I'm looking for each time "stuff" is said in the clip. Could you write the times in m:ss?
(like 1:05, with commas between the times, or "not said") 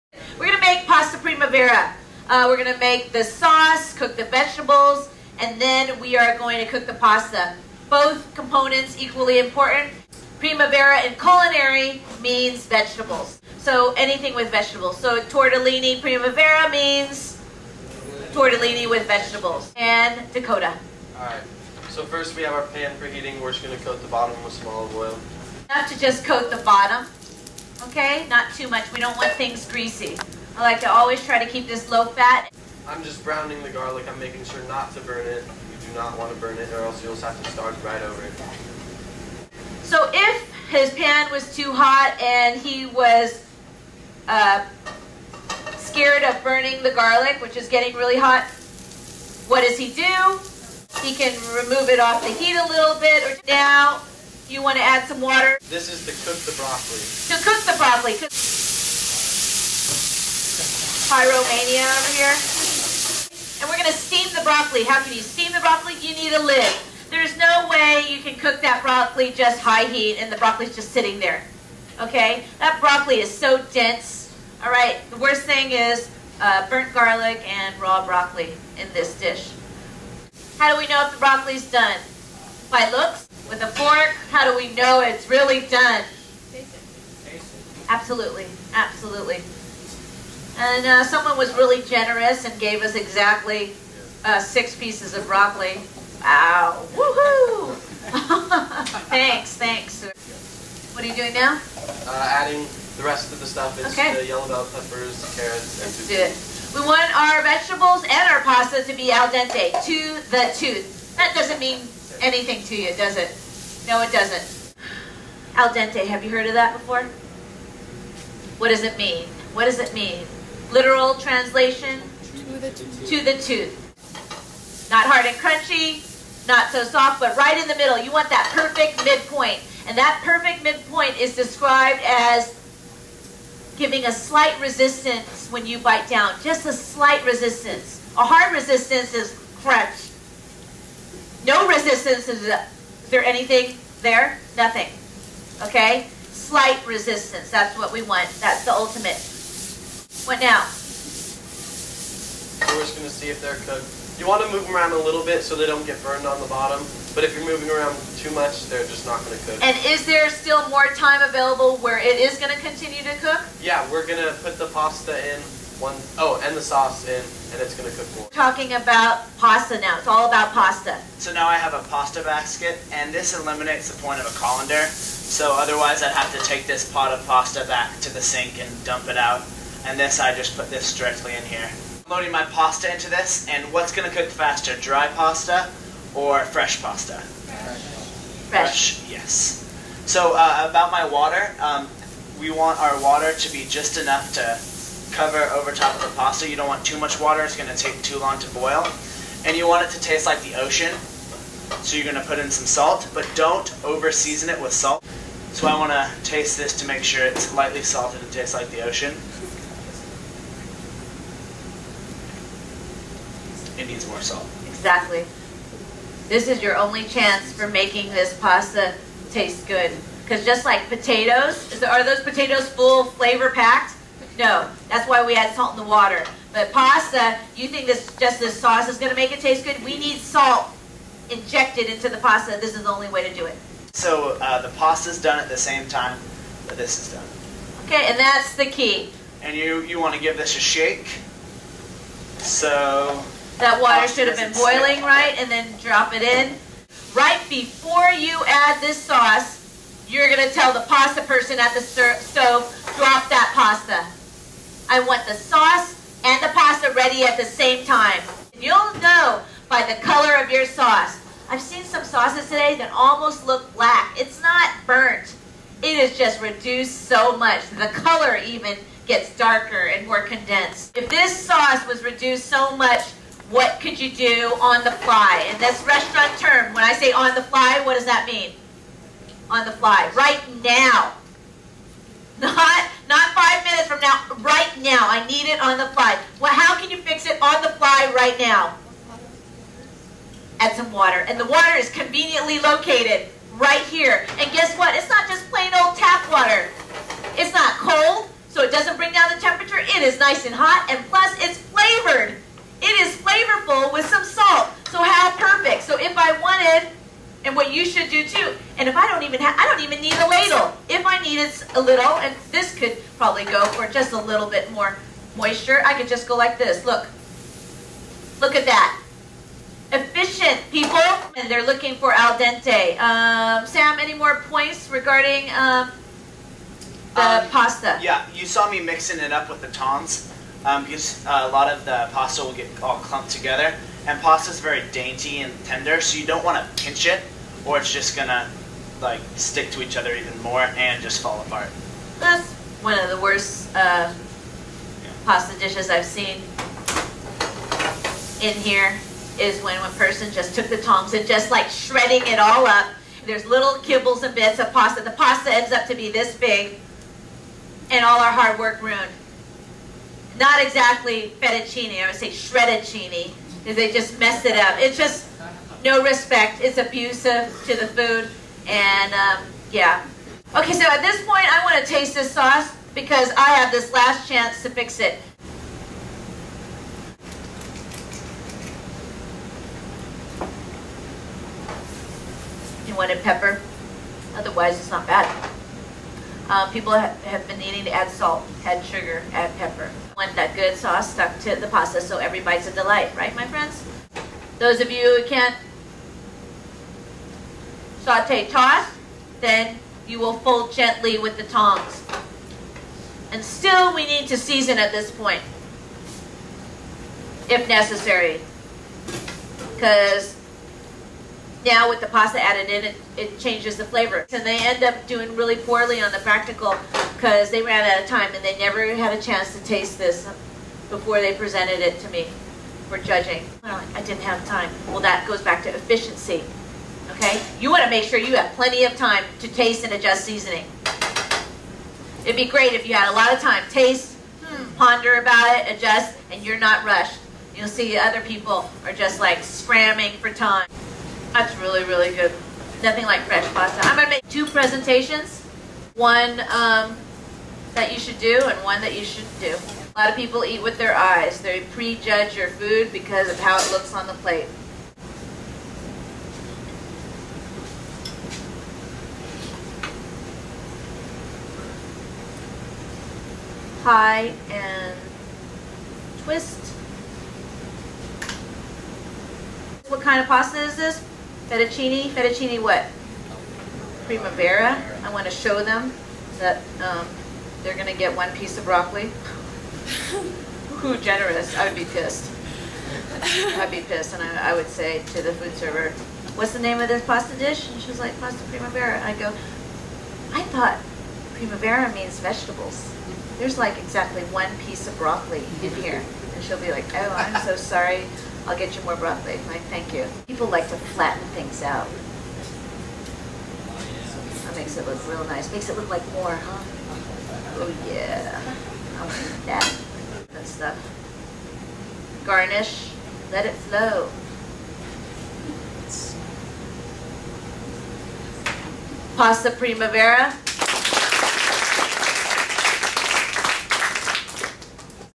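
1:43, 8:30.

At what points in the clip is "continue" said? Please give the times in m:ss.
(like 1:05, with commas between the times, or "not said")
2:42.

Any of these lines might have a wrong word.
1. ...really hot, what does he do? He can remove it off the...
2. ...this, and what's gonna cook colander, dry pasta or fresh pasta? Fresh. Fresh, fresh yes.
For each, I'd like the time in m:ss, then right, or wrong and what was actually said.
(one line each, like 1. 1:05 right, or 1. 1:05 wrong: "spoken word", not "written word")
1. 0:47 right
2. 3:03 wrong: "faster", not "colander".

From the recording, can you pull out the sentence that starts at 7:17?
You'll see other people are just like scramming for time.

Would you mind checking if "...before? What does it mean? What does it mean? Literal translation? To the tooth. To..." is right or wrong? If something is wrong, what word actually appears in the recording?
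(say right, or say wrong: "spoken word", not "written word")
right.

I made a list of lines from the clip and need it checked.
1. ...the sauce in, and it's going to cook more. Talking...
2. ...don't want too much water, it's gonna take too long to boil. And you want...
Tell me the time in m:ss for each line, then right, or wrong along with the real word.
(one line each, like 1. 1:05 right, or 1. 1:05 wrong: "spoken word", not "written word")
1. 2:46 right
2. 3:16 right.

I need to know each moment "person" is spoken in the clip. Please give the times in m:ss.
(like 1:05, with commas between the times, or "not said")
4:11, 5:49.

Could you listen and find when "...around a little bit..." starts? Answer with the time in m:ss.
2:34.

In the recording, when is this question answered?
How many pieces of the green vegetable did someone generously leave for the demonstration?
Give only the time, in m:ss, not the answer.
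1:34.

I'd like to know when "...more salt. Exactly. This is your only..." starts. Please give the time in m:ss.
3:34.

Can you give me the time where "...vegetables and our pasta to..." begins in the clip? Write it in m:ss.
1:47.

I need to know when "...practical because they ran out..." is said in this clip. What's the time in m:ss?
6:56.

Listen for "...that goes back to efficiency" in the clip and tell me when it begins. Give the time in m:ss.
7:04.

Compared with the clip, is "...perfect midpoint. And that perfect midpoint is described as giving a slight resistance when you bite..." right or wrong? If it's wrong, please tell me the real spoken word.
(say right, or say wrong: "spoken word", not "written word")
right.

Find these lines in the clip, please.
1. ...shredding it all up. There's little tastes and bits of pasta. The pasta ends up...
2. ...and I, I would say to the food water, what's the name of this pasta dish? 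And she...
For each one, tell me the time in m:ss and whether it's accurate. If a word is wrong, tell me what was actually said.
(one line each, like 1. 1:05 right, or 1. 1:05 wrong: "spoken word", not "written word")
1. 5:51 wrong: "kibbles", not "tastes"
2. 8:04 wrong: "server", not "water".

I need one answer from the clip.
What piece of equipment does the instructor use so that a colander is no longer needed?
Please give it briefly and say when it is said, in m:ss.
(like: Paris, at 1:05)
pasta basket, at 2:51.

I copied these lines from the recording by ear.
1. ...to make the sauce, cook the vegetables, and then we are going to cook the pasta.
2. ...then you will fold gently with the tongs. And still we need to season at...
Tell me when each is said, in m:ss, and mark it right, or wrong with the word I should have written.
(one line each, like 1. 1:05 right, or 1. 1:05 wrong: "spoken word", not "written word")
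1. 0:02 right
2. 6:39 right.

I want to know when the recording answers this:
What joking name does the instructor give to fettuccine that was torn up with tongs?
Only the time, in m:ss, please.
6:02.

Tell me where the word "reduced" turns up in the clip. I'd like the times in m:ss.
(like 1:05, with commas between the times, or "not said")
4:26, 4:32.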